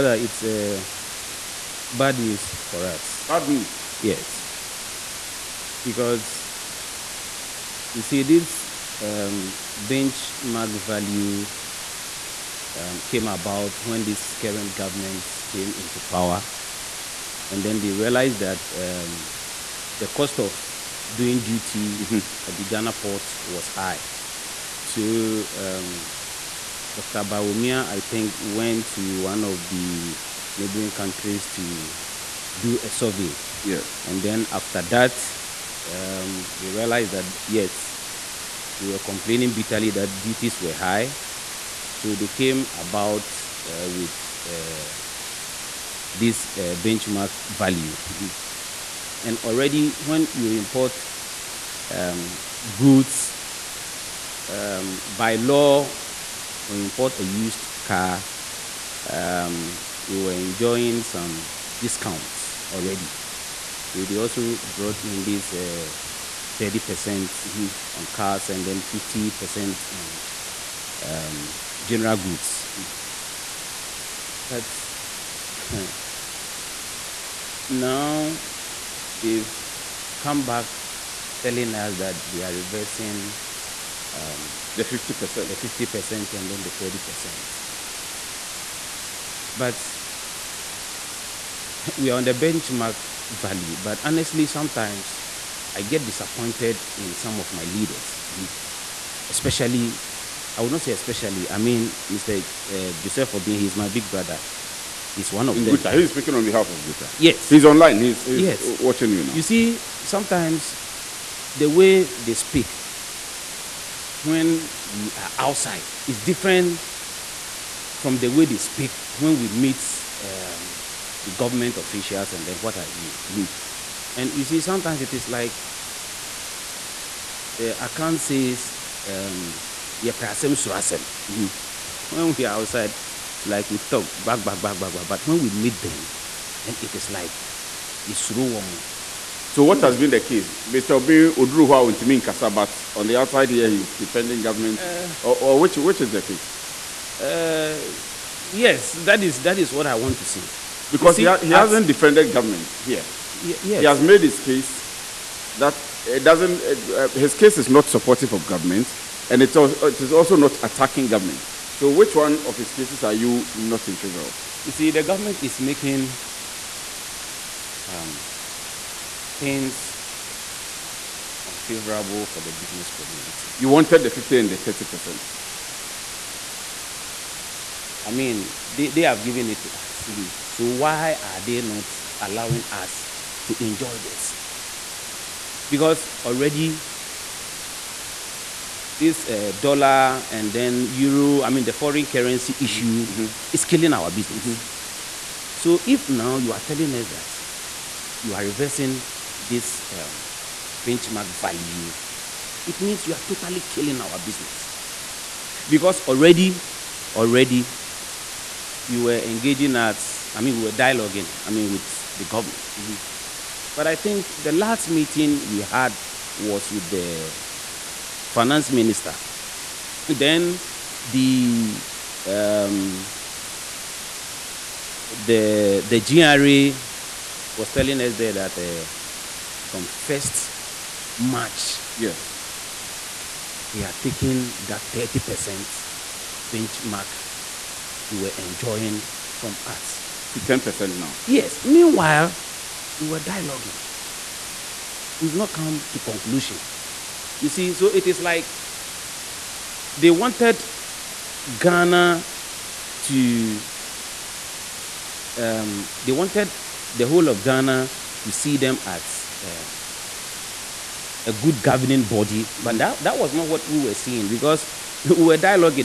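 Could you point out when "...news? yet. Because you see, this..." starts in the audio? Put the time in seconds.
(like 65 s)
3 s.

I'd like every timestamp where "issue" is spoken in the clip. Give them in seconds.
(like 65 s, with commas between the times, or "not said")
192 s.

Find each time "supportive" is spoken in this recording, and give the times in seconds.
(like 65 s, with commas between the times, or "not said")
157 s.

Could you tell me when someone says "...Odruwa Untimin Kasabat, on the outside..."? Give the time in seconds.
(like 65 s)
141 s.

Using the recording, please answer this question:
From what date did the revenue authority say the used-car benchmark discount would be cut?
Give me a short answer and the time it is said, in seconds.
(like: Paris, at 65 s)
1st March, at 229 s.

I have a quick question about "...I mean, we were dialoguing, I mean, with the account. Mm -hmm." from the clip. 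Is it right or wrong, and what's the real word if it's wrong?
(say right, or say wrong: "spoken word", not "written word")
wrong: "government", not "account".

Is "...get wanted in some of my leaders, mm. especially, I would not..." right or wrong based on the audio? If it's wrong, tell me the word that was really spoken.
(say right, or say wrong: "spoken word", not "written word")
wrong: "disappointed", not "wanted".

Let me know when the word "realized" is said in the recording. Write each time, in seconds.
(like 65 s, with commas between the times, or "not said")
17 s, 36 s.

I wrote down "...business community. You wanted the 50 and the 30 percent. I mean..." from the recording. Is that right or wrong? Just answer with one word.
right.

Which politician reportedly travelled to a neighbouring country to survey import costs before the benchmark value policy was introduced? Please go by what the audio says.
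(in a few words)
Dr. Bawumia.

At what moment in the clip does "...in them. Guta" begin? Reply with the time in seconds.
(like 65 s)
105 s.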